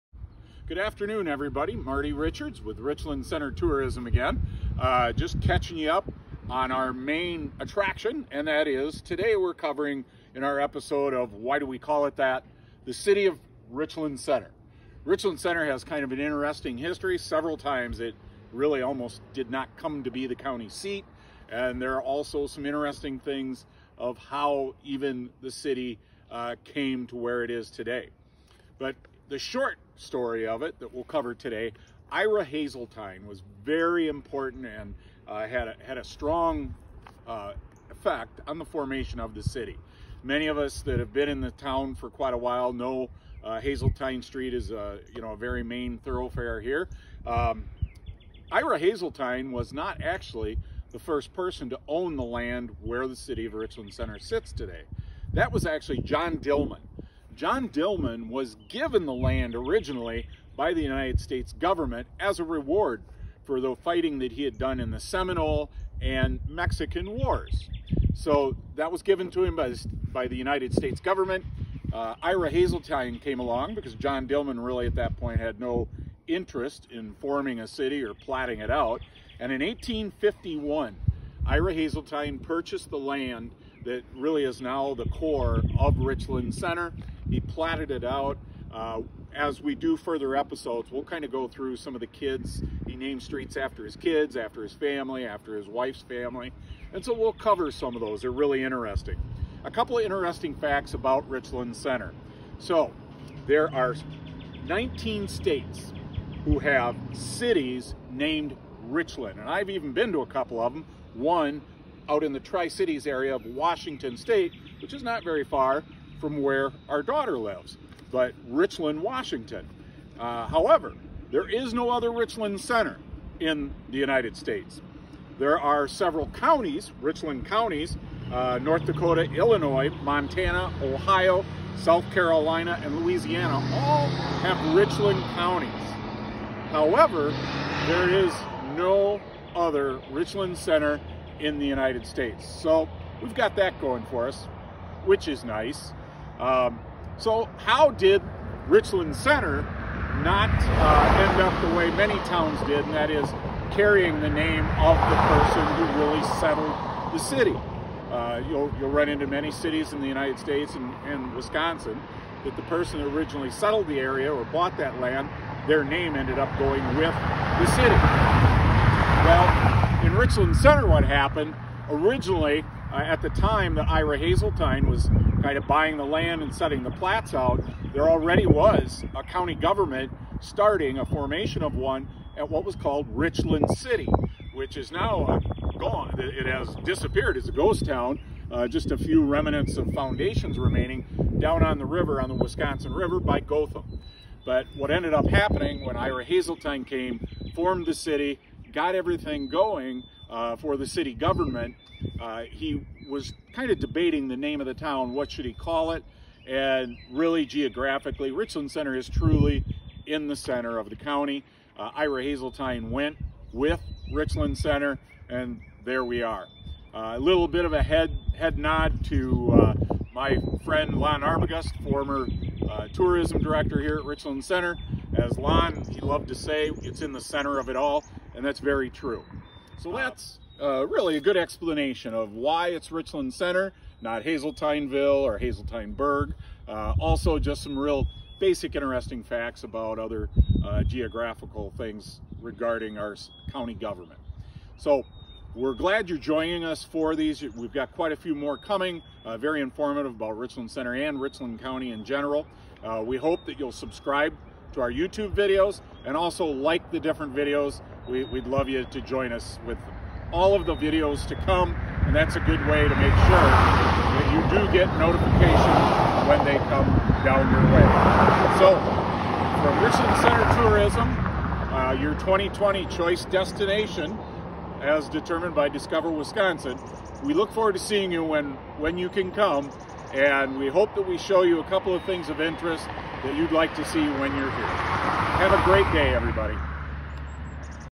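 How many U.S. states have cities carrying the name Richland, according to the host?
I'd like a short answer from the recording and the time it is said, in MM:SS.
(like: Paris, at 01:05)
19, at 01:44.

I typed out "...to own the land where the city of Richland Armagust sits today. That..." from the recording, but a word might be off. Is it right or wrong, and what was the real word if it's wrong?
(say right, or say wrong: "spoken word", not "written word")
wrong: "Center", not "Armagust".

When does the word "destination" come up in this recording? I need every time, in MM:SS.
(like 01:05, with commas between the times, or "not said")
04:33.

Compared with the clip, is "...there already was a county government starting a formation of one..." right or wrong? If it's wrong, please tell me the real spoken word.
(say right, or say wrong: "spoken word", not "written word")
right.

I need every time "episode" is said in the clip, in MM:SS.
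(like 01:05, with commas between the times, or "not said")
00:10, 01:30.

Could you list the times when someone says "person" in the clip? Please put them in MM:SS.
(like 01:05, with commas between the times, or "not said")
00:51, 02:35, 02:42.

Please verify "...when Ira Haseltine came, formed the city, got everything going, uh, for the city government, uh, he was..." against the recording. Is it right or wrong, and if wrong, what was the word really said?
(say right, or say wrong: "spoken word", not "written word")
right.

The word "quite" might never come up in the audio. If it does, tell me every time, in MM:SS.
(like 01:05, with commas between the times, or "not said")
00:42, 04:07.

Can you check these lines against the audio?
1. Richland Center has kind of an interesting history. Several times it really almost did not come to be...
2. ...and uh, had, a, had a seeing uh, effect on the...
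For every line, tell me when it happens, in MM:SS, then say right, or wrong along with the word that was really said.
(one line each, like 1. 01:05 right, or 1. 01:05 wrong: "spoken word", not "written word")
1. 00:15 right
2. 00:34 wrong: "strong", not "seeing".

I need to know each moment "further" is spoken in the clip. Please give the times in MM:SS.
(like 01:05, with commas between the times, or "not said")
01:29.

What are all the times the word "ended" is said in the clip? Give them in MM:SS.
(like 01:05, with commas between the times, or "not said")
02:46, 03:14.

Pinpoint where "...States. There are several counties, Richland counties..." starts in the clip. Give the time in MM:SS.
02:04.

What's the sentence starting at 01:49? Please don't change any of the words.
And I've even been to a couple of them.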